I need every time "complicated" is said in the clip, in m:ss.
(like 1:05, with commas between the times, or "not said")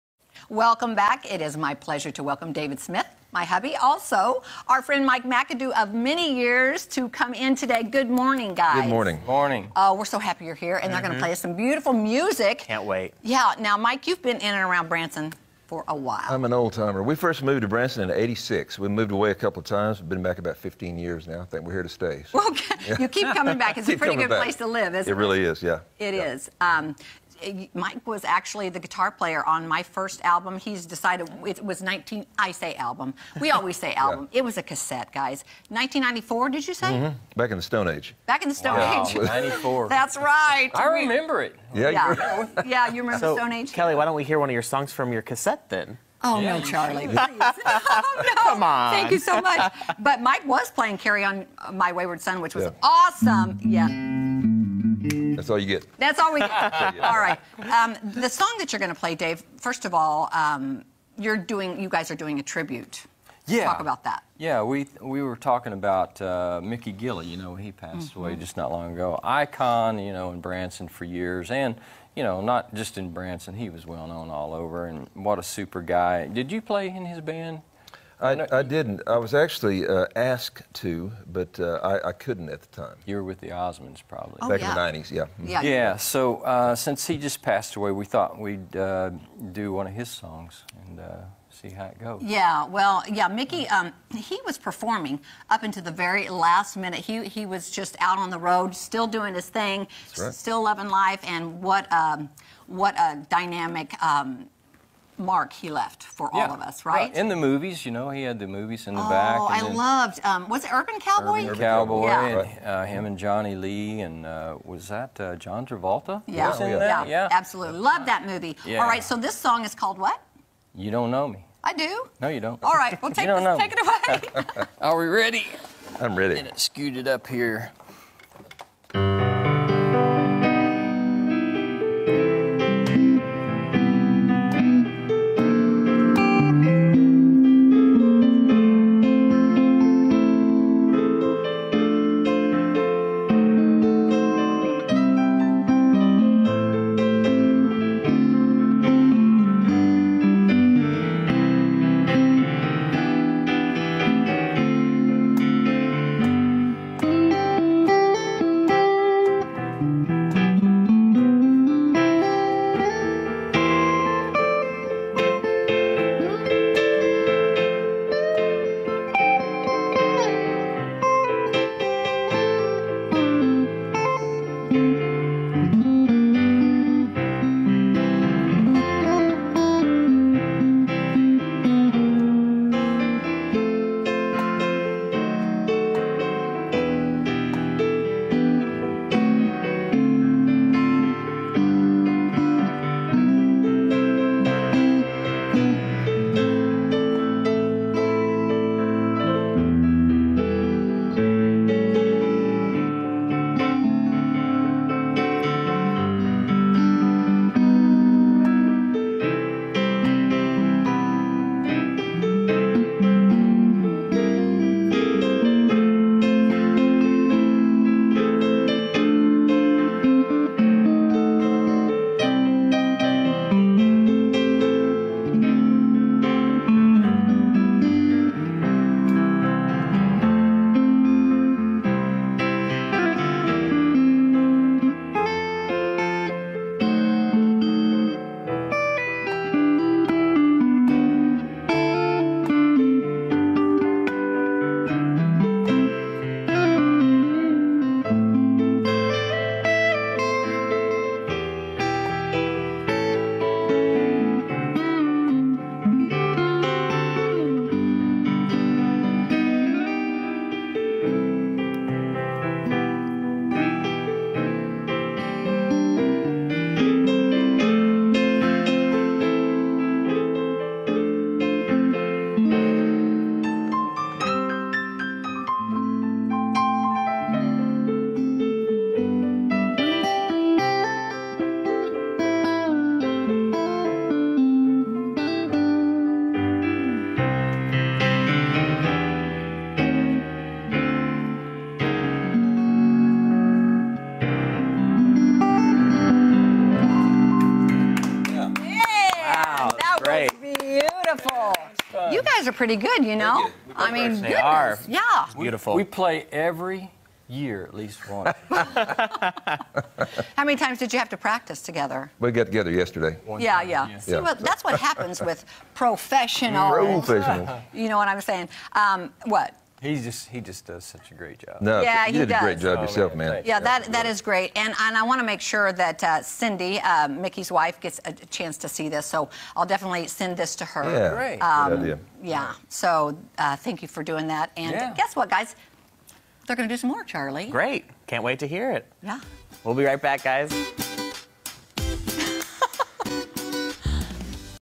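not said.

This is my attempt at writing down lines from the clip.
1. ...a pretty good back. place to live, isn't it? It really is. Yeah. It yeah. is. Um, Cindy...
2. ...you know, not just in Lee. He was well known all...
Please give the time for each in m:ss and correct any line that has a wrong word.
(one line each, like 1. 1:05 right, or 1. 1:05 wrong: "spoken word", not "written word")
1. 0:23 wrong: "Mike", not "Cindy"
2. 1:12 wrong: "Branson", not "Lee".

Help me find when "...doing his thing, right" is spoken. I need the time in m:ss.
1:39.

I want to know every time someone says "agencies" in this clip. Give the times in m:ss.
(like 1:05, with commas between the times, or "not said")
not said.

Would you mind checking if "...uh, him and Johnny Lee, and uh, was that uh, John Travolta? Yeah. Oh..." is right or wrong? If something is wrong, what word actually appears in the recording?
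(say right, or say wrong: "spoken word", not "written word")
right.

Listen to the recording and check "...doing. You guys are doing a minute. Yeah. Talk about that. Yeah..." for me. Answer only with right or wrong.
wrong.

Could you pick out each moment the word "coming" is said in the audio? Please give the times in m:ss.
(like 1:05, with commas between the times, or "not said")
0:23.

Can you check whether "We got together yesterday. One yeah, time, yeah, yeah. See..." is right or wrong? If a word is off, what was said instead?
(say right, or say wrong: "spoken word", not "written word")
right.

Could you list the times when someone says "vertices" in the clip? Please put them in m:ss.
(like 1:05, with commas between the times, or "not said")
not said.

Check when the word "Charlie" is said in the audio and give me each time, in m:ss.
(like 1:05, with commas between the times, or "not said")
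0:46, 5:37.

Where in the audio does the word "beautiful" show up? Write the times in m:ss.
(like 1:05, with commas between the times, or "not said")
0:11, 5:05.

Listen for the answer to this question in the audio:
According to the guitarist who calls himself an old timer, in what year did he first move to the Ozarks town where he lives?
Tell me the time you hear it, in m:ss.
0:18.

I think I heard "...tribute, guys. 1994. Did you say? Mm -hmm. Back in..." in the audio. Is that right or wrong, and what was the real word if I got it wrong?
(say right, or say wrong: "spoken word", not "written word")
wrong: "cassette", not "tribute".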